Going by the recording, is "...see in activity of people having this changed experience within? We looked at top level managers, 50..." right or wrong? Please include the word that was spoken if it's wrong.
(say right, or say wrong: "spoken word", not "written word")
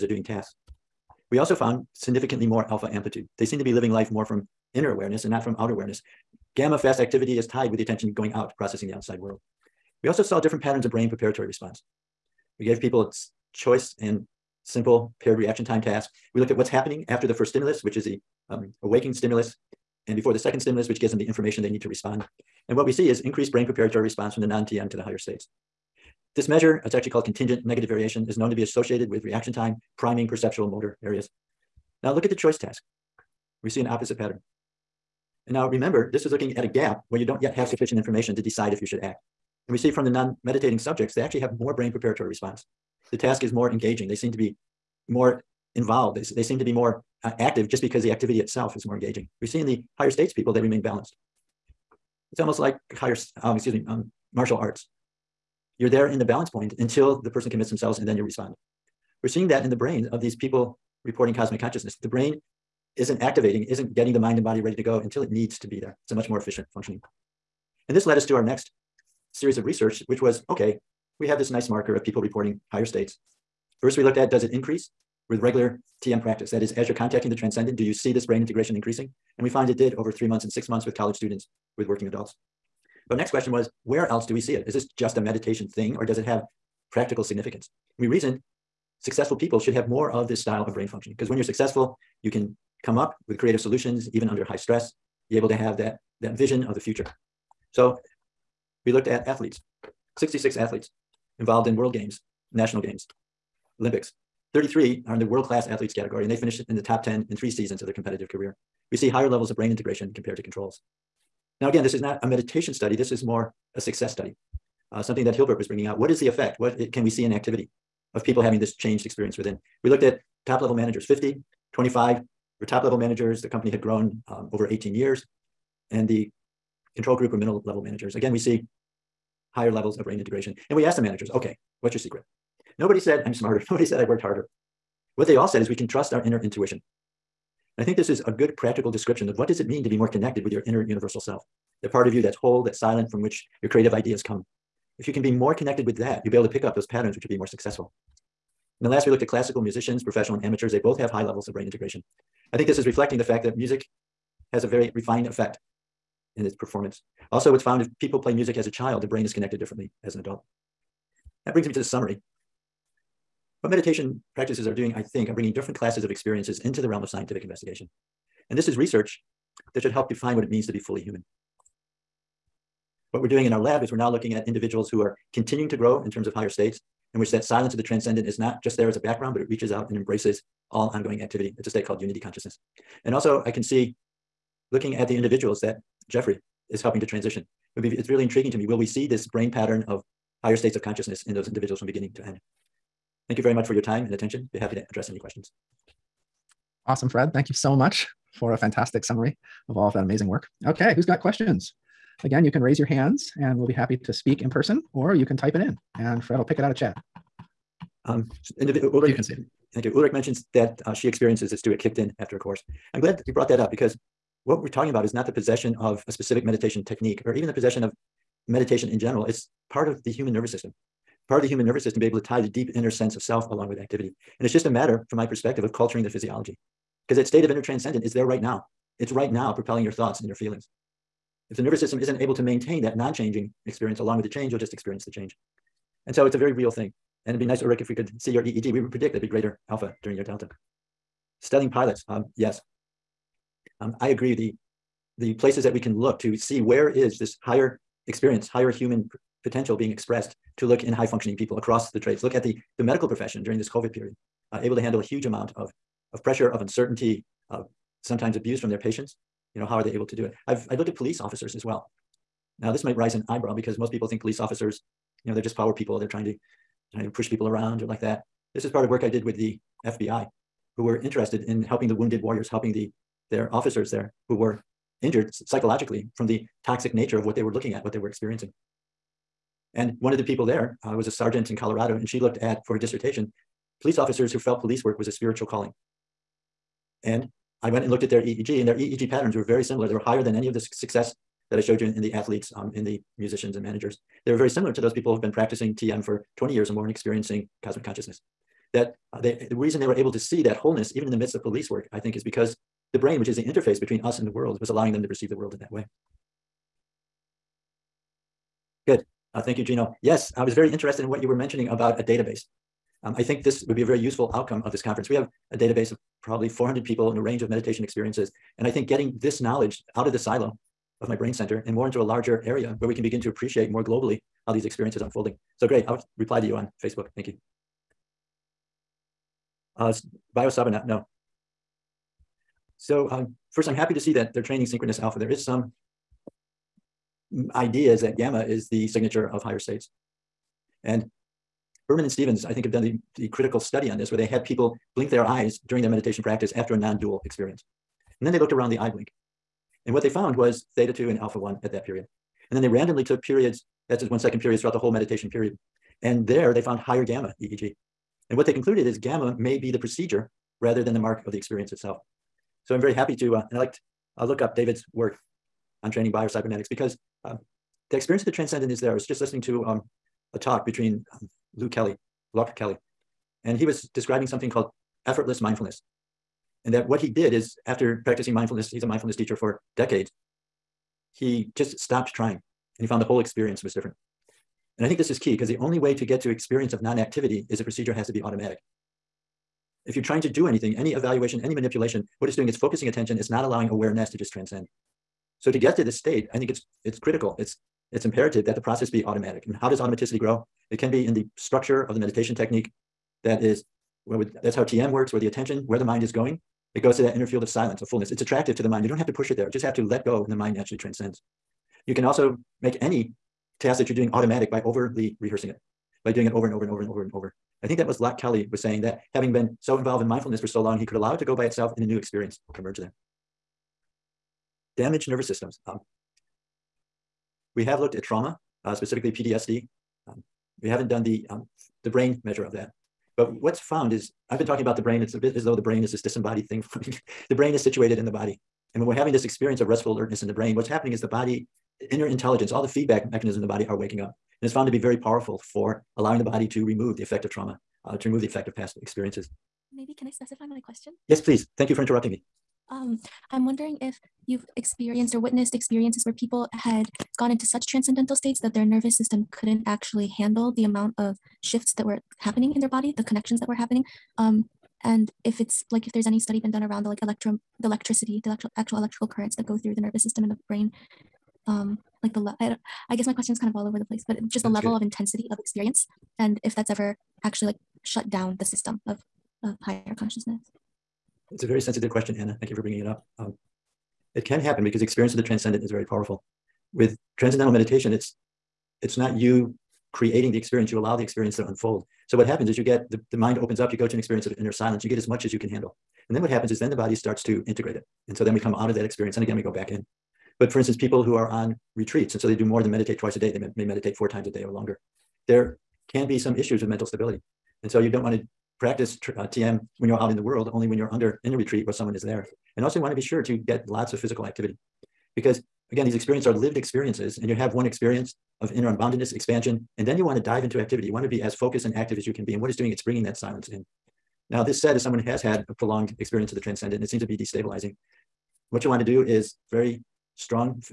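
right.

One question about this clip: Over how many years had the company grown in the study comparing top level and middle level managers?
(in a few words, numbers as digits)
18 years.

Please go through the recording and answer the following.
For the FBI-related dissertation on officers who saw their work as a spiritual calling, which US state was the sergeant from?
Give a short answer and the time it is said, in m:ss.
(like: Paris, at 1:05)
Colorado, at 4:41.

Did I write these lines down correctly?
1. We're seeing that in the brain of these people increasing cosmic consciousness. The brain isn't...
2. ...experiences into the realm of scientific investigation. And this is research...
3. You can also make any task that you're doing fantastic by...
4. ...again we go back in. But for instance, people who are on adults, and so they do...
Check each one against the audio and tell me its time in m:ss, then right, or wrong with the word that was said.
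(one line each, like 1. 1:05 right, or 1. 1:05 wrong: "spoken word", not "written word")
1. 0:59 wrong: "reporting", not "increasing"
2. 2:46 right
3. 6:51 wrong: "automatic", not "fantastic"
4. 8:19 wrong: "retreats", not "adults".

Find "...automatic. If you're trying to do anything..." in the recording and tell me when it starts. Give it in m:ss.
6:28.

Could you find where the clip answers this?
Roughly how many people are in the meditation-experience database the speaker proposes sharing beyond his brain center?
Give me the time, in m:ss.
5:16.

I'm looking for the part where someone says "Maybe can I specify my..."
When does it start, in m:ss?
7:29.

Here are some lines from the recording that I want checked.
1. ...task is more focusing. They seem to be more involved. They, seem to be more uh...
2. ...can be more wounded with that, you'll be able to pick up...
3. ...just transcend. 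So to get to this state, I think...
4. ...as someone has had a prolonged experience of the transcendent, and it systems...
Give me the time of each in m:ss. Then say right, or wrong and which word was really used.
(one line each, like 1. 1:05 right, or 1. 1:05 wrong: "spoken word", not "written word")
1. 0:43 wrong: "engaging", not "focusing"
2. 2:25 wrong: "connected", not "wounded"
3. 6:34 right
4. 8:44 wrong: "seems", not "systems".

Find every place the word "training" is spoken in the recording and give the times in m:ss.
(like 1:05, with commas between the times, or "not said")
5:34, 6:05.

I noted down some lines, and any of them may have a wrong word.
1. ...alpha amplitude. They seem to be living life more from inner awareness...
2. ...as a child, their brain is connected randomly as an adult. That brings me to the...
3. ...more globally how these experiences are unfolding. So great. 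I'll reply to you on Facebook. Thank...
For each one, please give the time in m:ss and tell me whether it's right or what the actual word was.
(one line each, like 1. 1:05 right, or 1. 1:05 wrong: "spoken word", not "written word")
1. 0:02 right
2. 2:38 wrong: "differently", not "randomly"
3. 5:23 right.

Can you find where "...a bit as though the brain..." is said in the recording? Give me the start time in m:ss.
7:15.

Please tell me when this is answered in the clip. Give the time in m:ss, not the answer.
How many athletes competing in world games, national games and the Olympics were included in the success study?
1:40.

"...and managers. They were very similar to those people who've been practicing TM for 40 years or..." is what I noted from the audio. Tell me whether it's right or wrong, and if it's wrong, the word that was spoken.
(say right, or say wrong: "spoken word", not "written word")
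wrong: "20", not "40".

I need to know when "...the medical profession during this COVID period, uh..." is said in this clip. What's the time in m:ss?
4:12.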